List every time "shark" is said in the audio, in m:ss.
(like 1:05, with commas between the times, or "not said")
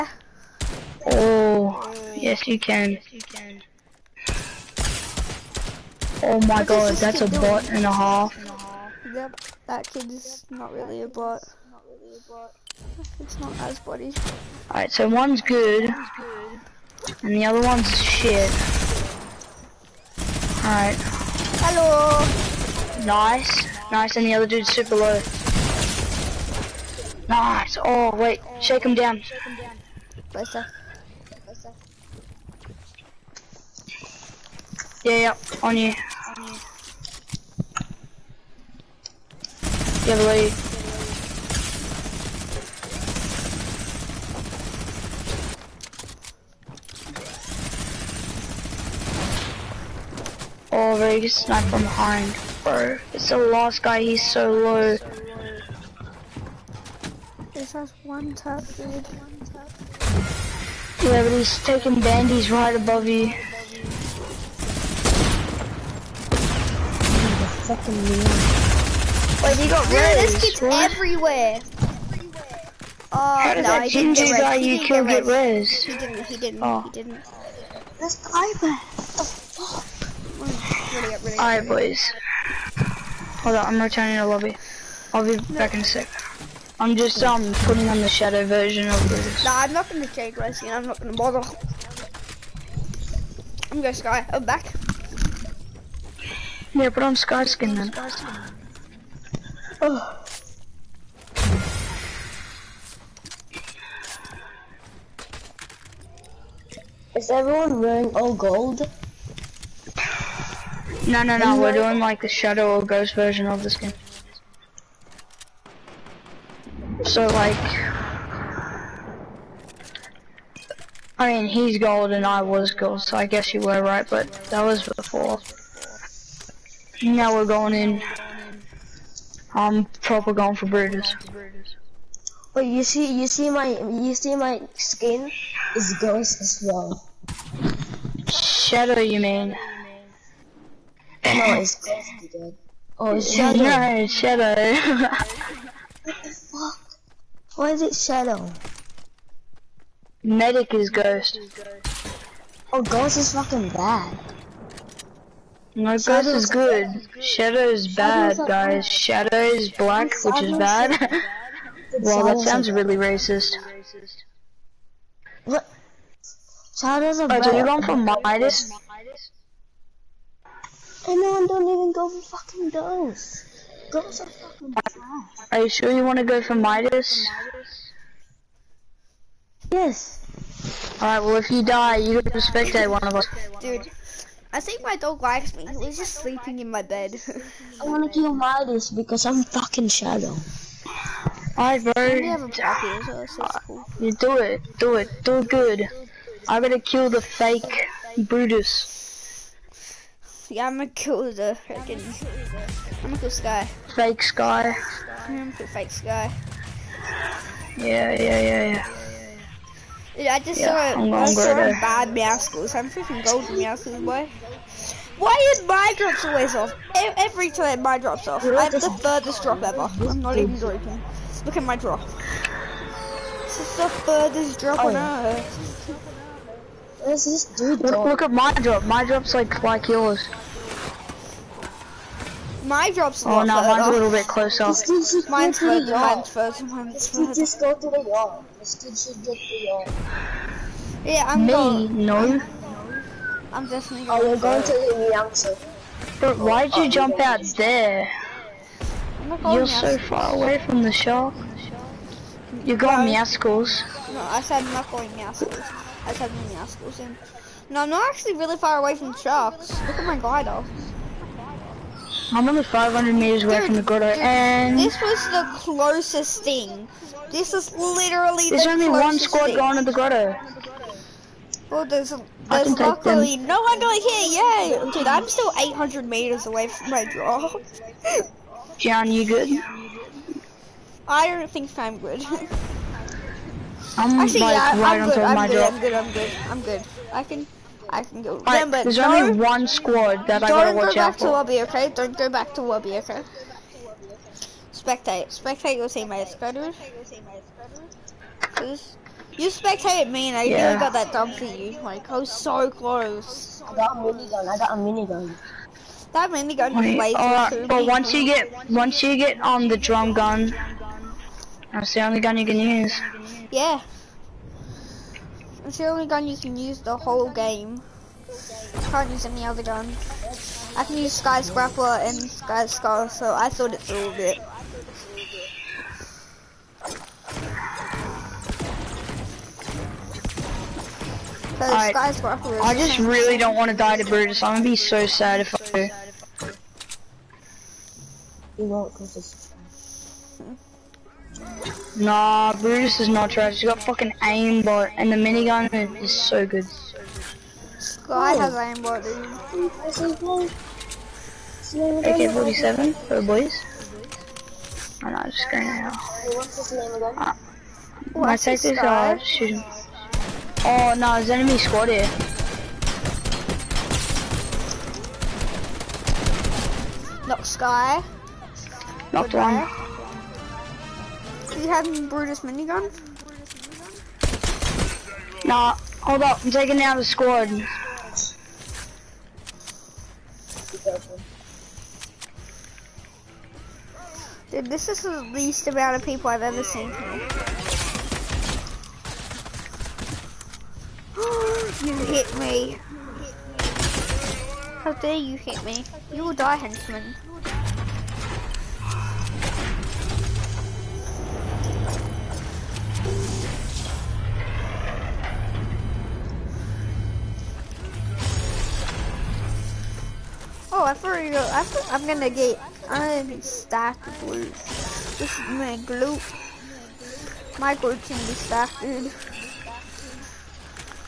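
4:10, 4:19.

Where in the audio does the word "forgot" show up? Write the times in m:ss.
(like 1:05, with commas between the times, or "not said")
6:50.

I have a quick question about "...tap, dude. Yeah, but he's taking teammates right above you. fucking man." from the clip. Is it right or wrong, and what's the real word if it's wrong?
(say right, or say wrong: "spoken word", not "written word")
wrong: "bandies", not "teammates".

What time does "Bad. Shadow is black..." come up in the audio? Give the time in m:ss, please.
2:38.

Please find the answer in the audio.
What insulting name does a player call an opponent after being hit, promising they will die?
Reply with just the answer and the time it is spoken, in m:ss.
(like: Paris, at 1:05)
Henchman, at 6:36.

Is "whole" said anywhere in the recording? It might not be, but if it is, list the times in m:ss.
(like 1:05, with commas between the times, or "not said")
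5:16.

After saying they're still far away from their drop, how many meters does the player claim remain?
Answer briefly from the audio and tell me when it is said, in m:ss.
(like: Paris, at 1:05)
800, at 4:35.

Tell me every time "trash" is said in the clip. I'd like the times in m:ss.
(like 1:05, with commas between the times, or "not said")
2:54, 5:43.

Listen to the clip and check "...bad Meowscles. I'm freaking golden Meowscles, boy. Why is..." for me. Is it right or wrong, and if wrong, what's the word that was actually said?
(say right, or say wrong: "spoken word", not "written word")
right.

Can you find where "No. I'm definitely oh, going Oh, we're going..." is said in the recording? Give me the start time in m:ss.
4:02.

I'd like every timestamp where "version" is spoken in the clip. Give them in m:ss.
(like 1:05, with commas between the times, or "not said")
1:28, 1:53.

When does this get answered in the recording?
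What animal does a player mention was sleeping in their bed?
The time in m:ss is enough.
3:04.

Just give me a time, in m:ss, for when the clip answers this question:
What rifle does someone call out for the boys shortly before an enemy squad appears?
5:52.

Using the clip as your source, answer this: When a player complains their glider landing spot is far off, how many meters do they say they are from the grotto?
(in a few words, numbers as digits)
500.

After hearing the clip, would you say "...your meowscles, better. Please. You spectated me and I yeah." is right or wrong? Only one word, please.
wrong.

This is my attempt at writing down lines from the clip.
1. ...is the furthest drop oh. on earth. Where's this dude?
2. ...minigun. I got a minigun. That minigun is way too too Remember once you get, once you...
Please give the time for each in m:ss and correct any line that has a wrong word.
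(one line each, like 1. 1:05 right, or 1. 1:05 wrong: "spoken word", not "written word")
1. 3:43 right
2. 5:04 wrong: "But", not "Remember".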